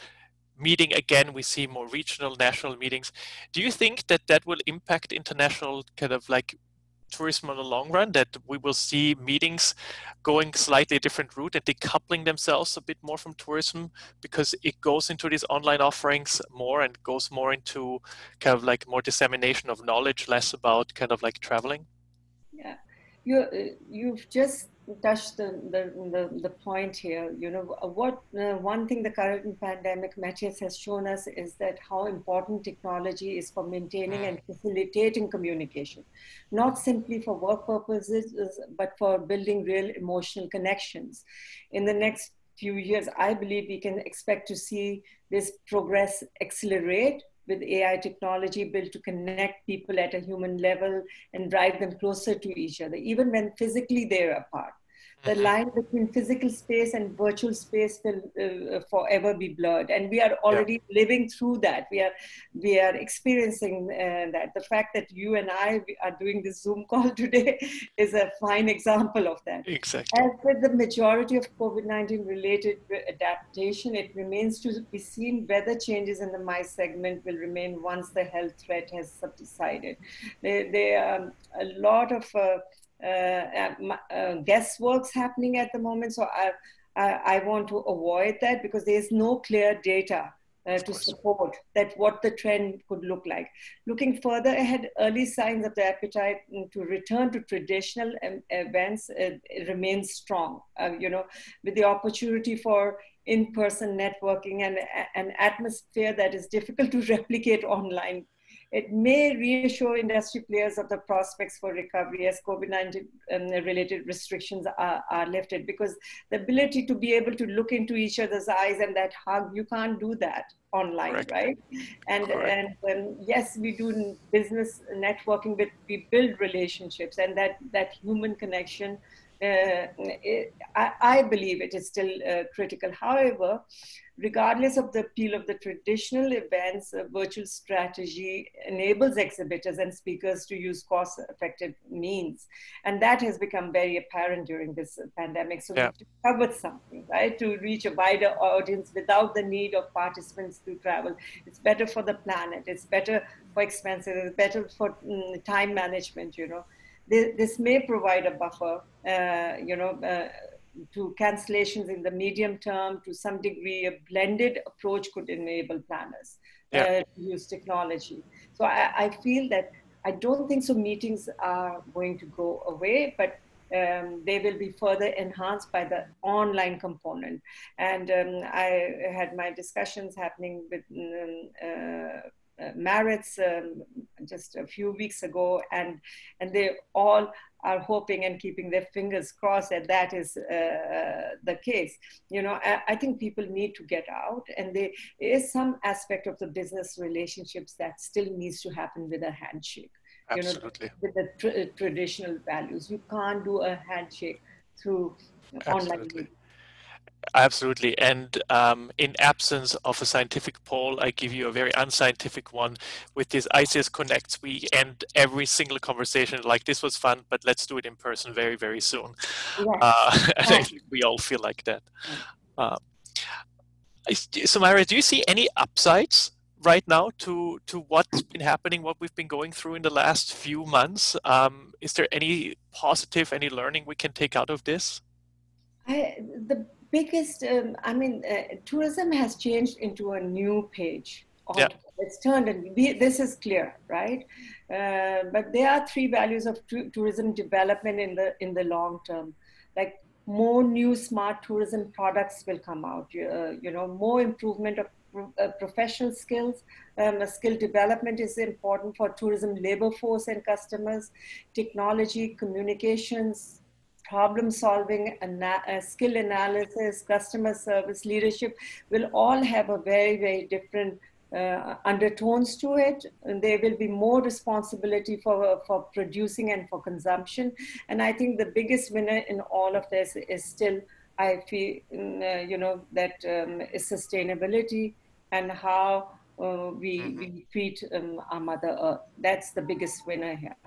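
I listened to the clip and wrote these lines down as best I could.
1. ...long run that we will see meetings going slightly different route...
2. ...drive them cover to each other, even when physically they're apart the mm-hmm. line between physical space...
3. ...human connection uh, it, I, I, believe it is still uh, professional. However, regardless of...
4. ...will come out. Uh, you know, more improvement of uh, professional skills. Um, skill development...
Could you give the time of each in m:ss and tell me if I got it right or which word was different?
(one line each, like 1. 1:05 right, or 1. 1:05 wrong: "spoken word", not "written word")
1. 0:07 right
2. 0:51 wrong: "closer", not "cover"
3. 2:07 wrong: "critical", not "professional"
4. 4:12 right.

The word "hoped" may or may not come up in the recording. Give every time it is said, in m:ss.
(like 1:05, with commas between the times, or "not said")
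not said.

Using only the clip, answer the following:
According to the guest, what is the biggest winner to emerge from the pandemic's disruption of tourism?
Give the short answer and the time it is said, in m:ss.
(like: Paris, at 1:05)
Sustainability, at 4:43.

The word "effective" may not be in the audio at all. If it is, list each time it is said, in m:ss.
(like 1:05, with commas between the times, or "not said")
2:21.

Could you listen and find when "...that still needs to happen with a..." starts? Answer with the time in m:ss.
3:17.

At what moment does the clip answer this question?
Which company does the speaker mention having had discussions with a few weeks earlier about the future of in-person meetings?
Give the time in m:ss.
3:02.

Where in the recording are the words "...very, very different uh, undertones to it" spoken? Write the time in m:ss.
4:29.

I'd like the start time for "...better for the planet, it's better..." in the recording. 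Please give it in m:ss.
2:31.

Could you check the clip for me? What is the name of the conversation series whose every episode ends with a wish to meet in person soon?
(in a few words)
ICS Connects.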